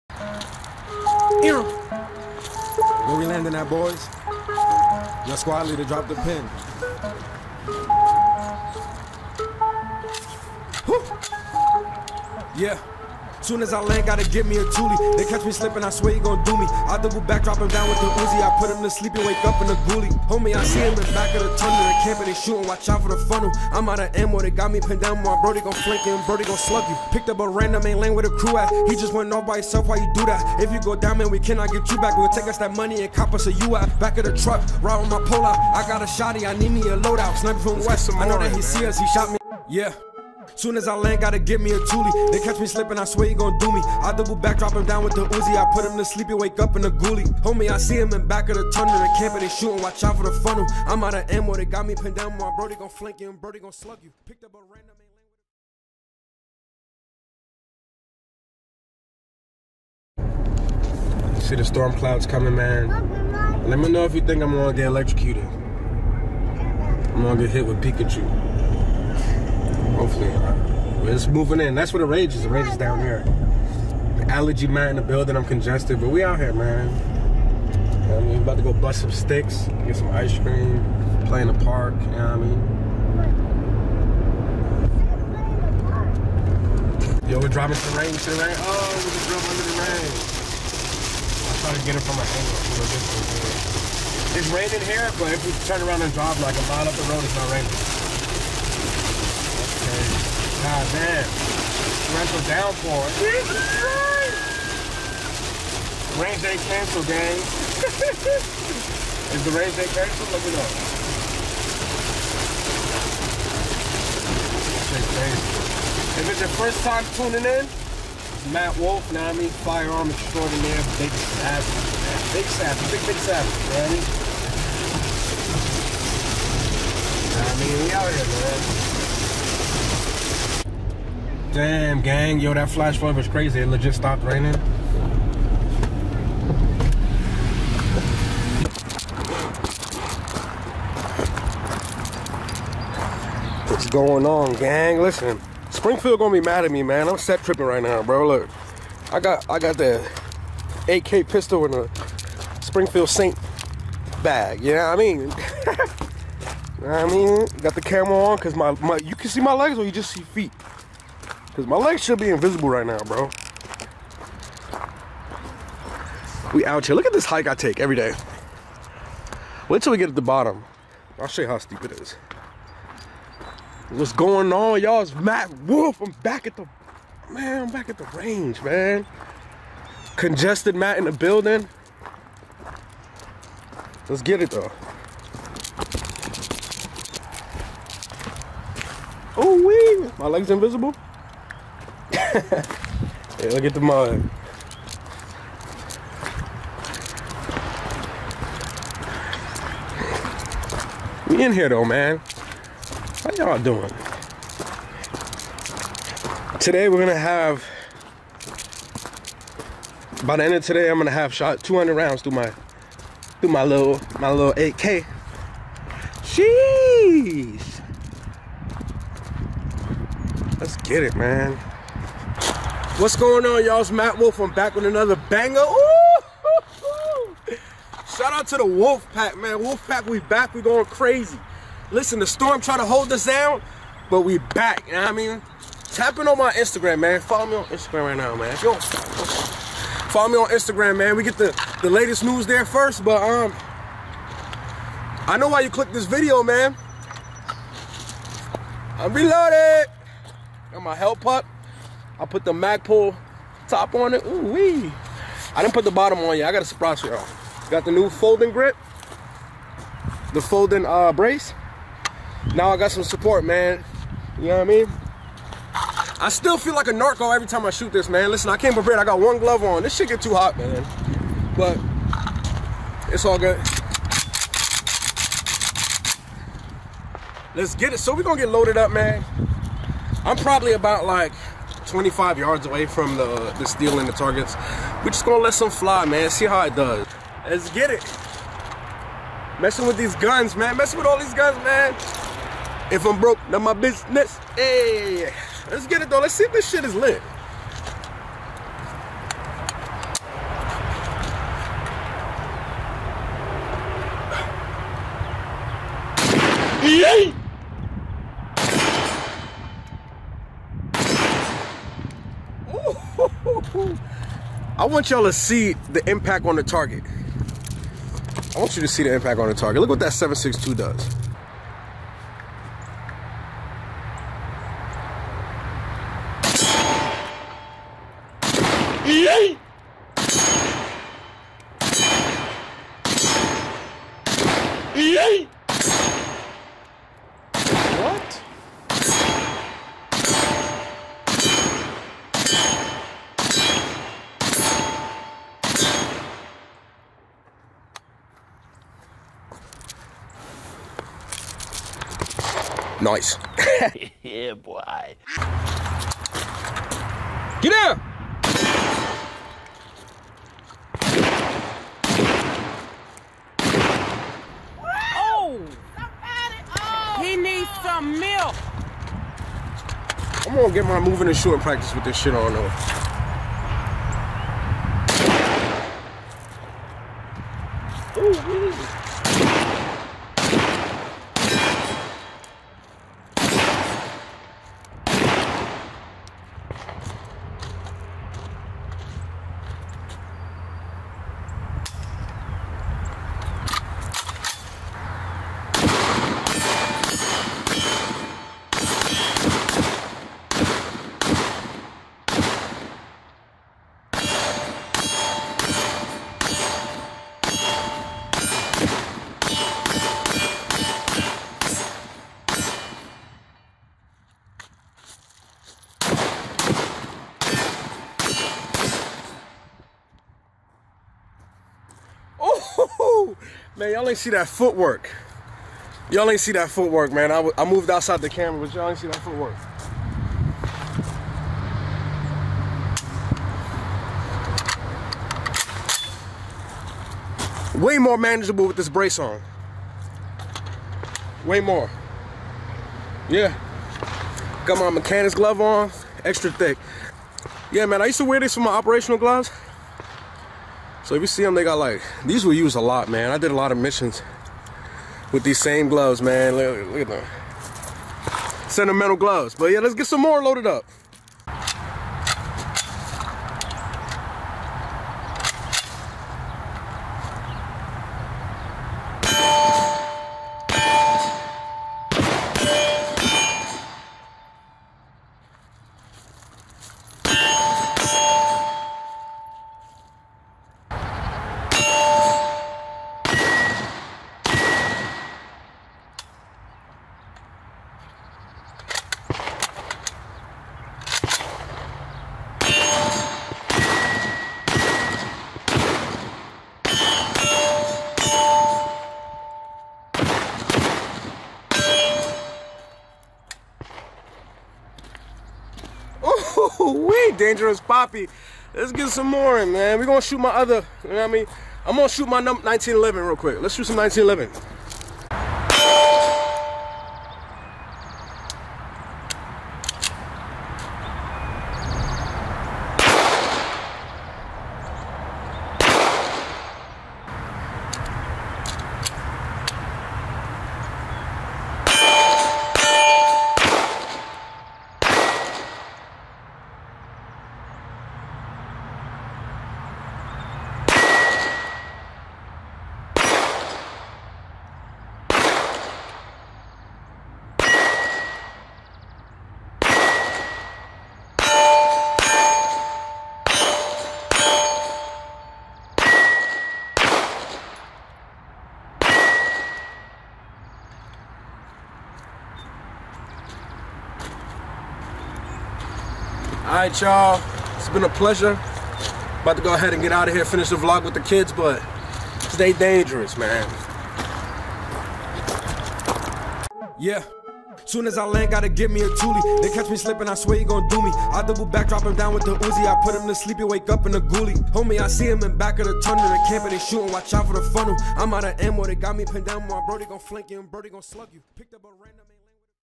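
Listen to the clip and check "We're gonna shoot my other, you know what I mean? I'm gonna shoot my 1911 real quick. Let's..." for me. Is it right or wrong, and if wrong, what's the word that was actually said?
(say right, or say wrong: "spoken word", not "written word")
right.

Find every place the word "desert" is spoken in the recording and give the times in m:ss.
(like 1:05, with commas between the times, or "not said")
not said.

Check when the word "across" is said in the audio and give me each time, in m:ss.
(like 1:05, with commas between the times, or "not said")
not said.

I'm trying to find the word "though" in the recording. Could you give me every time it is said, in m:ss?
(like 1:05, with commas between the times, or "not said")
3:04, 3:21, 4:56, 6:12.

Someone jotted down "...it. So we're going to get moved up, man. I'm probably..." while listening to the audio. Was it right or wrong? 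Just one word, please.
wrong.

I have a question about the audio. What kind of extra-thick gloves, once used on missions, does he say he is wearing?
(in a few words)
mechanic's glove.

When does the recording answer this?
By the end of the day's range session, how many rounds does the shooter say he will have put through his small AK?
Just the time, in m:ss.
3:31.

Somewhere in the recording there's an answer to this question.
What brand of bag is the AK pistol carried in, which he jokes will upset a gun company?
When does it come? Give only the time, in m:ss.
2:32.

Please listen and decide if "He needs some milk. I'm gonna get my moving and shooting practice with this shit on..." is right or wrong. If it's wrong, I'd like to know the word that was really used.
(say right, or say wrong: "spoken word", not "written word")
right.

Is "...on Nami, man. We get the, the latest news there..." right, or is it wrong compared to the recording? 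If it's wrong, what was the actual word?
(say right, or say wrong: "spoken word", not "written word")
wrong: "Instagram", not "Nami".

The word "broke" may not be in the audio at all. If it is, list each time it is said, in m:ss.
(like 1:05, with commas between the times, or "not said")
4:53.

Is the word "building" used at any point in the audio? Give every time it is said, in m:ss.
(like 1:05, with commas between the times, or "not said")
1:15, 3:01.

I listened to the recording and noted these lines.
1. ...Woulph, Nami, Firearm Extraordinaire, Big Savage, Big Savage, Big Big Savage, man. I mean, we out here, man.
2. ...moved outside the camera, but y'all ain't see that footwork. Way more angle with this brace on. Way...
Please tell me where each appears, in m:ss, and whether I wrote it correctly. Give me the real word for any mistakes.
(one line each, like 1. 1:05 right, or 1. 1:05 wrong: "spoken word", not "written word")
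1. 1:58 right
2. 7:07 wrong: "manageable", not "angle".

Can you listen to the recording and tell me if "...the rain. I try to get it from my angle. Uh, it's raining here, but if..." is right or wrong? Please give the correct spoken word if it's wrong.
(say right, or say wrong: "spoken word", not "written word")
right.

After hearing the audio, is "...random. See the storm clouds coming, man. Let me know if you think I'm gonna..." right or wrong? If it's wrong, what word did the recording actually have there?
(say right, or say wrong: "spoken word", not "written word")
right.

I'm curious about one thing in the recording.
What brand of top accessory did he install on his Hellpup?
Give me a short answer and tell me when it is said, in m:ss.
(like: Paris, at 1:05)
Magpul, at 4:12.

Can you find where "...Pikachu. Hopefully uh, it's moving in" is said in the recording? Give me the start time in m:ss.
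1:07.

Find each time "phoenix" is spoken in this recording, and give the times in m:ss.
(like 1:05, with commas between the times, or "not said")
not said.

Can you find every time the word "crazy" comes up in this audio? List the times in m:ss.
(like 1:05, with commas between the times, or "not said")
2:13, 3:50.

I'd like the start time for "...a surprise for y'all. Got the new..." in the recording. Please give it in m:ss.
4:16.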